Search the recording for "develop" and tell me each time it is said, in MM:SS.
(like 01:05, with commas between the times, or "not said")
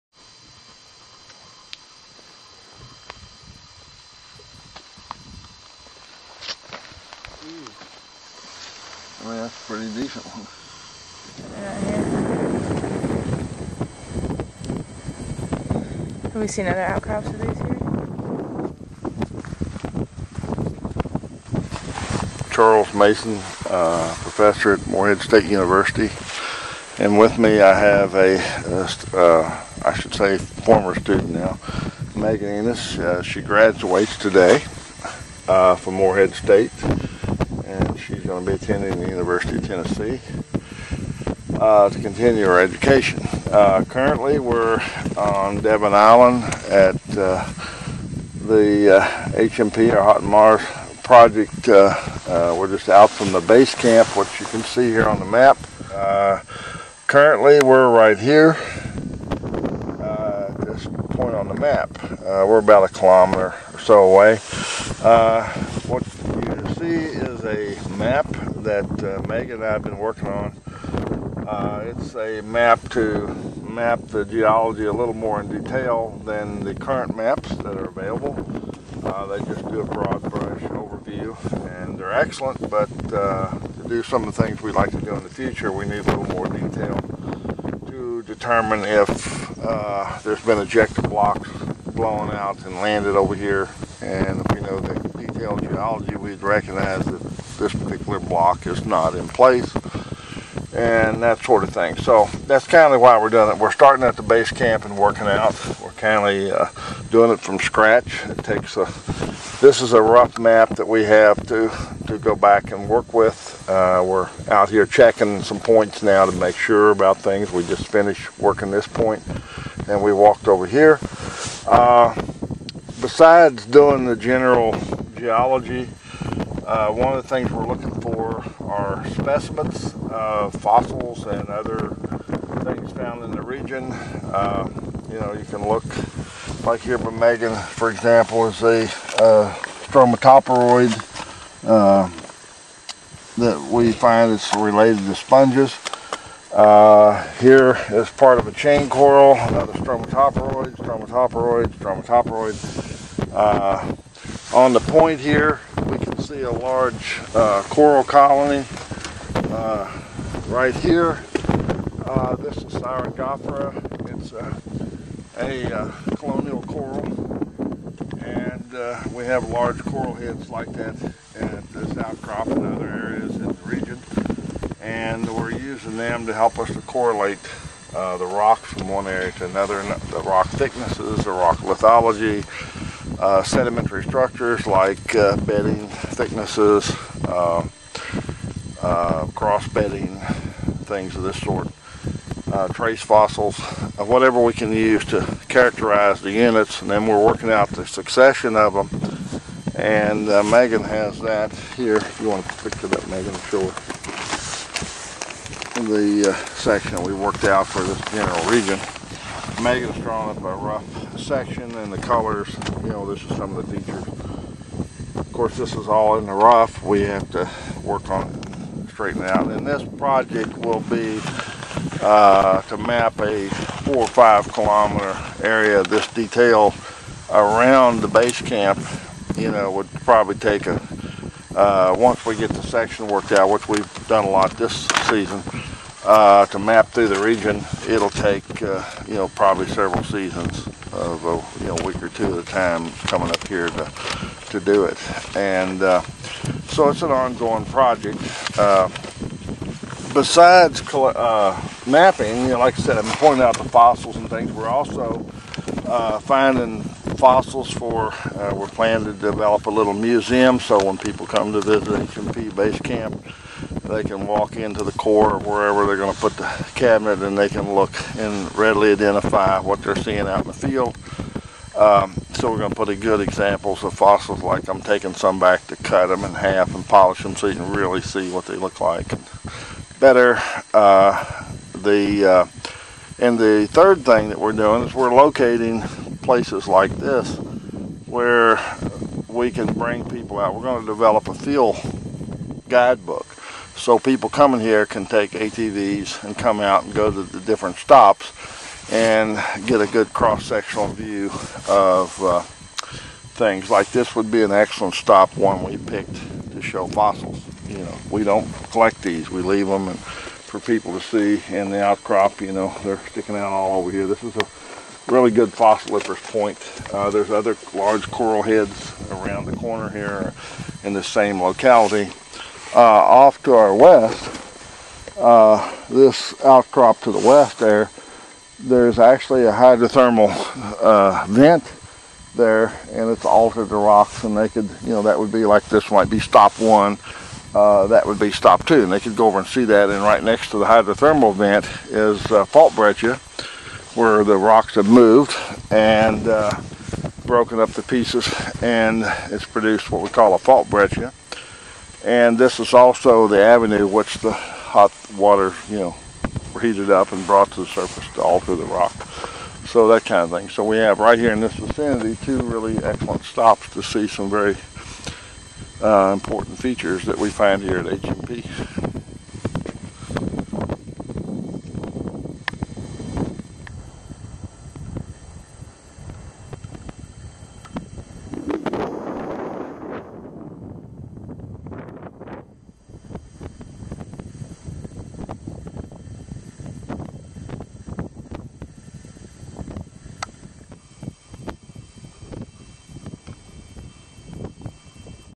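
04:19, 04:50.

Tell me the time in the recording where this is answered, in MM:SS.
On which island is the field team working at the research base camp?
00:45.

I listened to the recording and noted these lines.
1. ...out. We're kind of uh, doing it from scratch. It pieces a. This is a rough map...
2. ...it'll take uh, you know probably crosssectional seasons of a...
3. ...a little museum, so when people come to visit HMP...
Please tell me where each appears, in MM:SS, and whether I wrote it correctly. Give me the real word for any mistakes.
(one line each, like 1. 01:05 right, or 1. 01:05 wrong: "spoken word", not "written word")
1. 01:45 wrong: "takes", not "pieces"
2. 03:57 wrong: "several", not "crosssectional"
3. 04:19 right.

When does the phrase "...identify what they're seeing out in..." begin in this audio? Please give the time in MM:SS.
04:28.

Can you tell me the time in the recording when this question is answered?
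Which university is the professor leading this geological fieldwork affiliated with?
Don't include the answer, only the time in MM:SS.
00:24.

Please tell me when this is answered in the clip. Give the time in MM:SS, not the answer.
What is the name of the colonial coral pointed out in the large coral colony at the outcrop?
02:42.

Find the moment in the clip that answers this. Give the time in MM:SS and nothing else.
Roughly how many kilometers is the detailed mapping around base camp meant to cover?
03:43.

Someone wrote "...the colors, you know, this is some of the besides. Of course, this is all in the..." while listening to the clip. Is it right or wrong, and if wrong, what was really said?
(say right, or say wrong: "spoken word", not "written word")
wrong: "features", not "besides".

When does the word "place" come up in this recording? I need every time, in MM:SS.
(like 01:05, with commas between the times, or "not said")
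01:39, 04:46.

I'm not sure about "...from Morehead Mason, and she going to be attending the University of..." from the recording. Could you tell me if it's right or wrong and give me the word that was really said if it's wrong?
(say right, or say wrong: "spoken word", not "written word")
wrong: "State", not "Mason".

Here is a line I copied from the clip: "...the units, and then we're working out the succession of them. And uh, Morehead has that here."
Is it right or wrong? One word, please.
wrong.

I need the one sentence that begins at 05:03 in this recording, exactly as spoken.
Like this would be an excellent stop, one we picked to show fossils.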